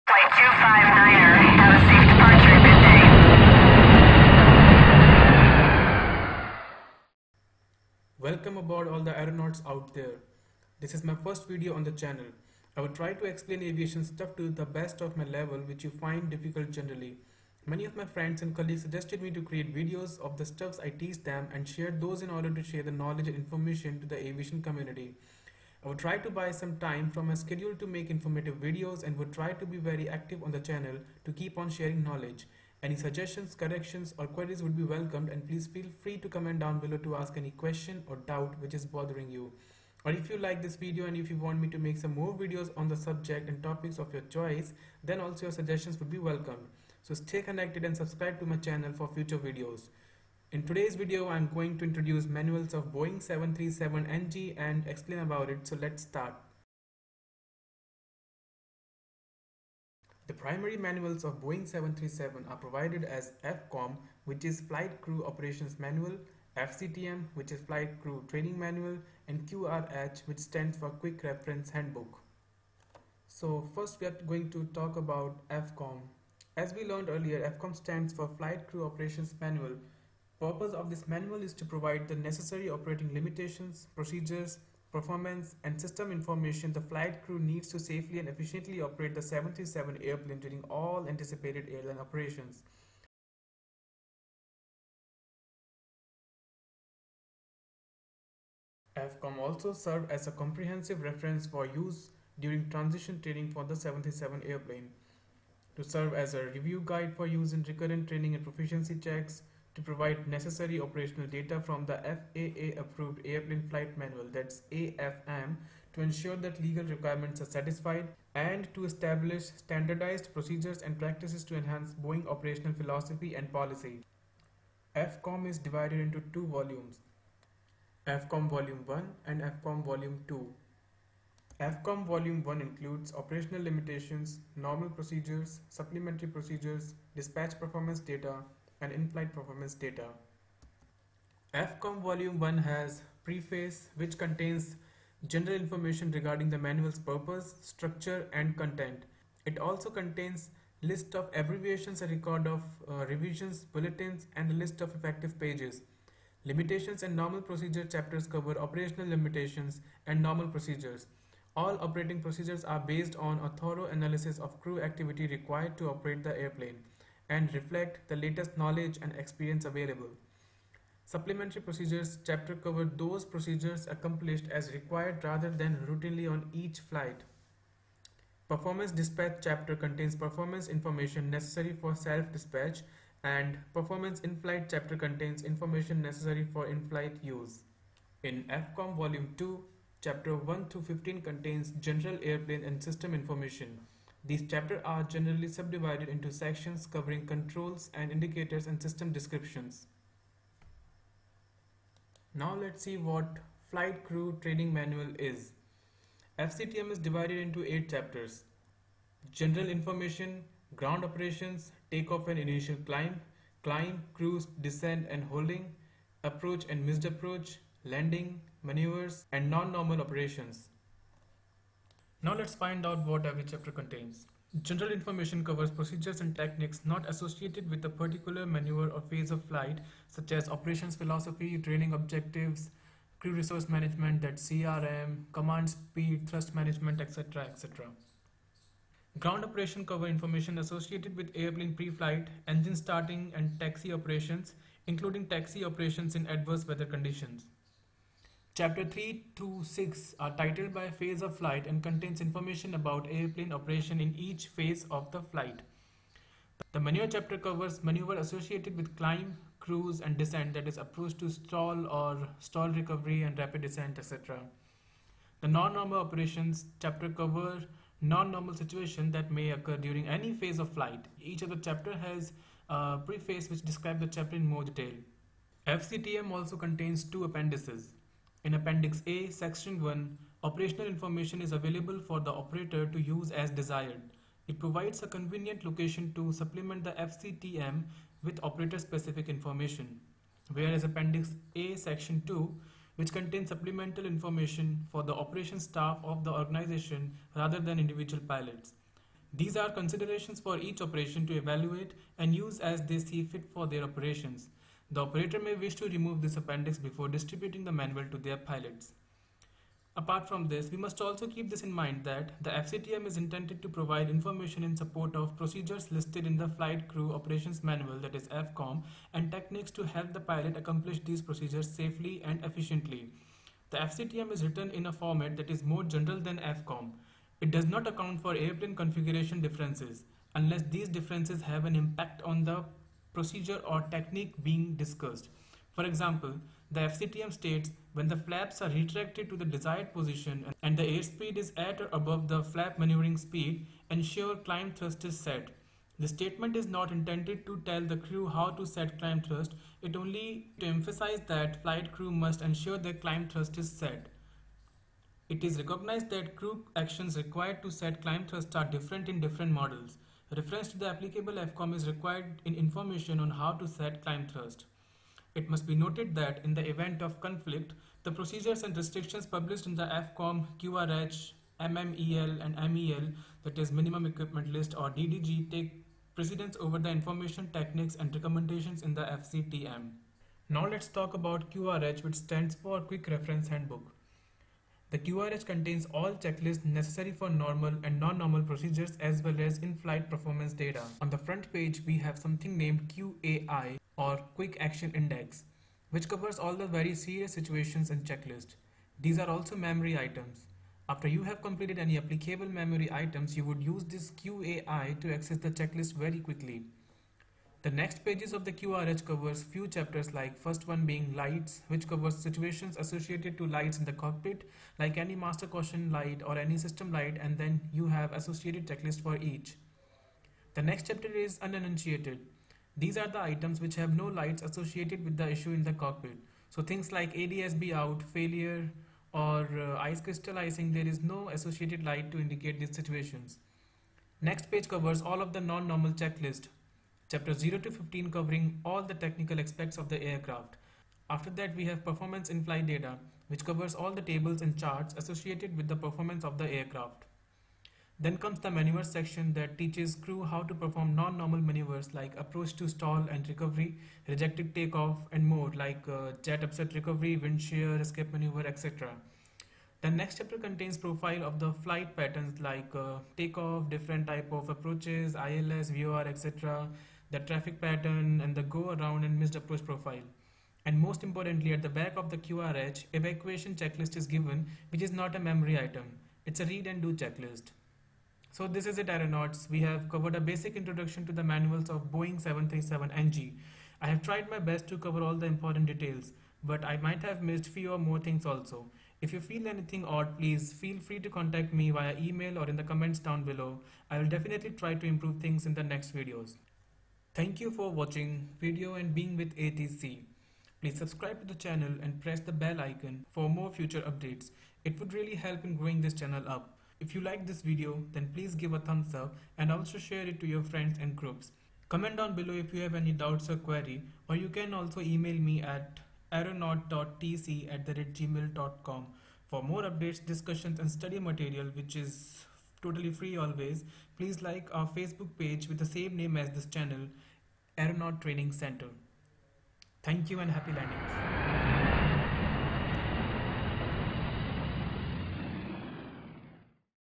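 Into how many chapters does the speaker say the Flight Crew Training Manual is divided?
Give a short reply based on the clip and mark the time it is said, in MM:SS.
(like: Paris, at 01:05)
8, at 03:27.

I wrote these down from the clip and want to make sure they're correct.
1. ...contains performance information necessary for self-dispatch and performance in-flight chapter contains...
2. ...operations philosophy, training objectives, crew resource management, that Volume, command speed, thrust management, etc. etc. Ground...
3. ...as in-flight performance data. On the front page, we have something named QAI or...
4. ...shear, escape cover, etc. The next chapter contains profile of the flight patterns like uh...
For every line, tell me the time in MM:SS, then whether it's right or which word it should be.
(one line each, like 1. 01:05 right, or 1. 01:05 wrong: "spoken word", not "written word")
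1. 02:59 right
2. 03:50 wrong: "CRM", not "Volume"
3. 06:29 right
4. 07:37 wrong: "maneuver", not "cover".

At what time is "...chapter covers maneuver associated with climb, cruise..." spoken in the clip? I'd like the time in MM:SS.
04:17.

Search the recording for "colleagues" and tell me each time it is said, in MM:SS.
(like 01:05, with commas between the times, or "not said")
00:18.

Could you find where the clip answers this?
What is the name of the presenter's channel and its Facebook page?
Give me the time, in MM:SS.
08:47.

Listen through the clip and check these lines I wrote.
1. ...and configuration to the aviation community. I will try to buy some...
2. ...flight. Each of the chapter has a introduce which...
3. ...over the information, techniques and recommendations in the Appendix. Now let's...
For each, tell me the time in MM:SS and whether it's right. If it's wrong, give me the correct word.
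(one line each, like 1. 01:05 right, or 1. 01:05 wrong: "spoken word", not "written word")
1. 00:23 wrong: "information", not "configuration"
2. 04:30 wrong: "preface", not "introduce"
3. 06:16 wrong: "FCTM", not "Appendix".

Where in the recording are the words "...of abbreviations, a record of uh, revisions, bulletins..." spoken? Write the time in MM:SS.
02:31.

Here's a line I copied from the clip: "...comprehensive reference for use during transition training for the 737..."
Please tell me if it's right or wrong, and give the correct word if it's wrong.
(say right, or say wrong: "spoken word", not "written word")
right.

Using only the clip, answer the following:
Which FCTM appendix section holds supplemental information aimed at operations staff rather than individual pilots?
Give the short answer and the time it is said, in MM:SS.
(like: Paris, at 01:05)
Appendix A, Section 2, at 04:50.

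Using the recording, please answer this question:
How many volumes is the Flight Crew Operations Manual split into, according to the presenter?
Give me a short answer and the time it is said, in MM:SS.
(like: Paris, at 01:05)
2, at 02:06.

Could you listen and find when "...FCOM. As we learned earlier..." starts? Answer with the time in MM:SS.
01:15.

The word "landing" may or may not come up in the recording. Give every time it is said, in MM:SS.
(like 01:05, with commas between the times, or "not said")
03:37, 08:50.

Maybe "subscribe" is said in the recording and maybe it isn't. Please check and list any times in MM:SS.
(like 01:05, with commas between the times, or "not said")
00:47, 08:20.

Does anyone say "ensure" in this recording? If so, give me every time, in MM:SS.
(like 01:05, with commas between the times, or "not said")
01:56, 05:43, 05:52.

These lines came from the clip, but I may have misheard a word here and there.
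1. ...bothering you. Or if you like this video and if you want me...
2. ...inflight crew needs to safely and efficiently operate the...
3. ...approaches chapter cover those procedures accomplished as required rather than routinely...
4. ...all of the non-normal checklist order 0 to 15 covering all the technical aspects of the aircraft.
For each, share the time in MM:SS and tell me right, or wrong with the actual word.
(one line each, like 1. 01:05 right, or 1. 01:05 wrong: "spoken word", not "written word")
1. 00:38 right
2. 01:26 wrong: "flight", not "inflight"
3. 02:51 wrong: "procedures", not "approaches"
4. 07:15 wrong: "chapter", not "order".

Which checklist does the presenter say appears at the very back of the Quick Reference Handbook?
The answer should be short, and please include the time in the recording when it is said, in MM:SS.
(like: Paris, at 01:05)
Evacuation checklist, at 07:52.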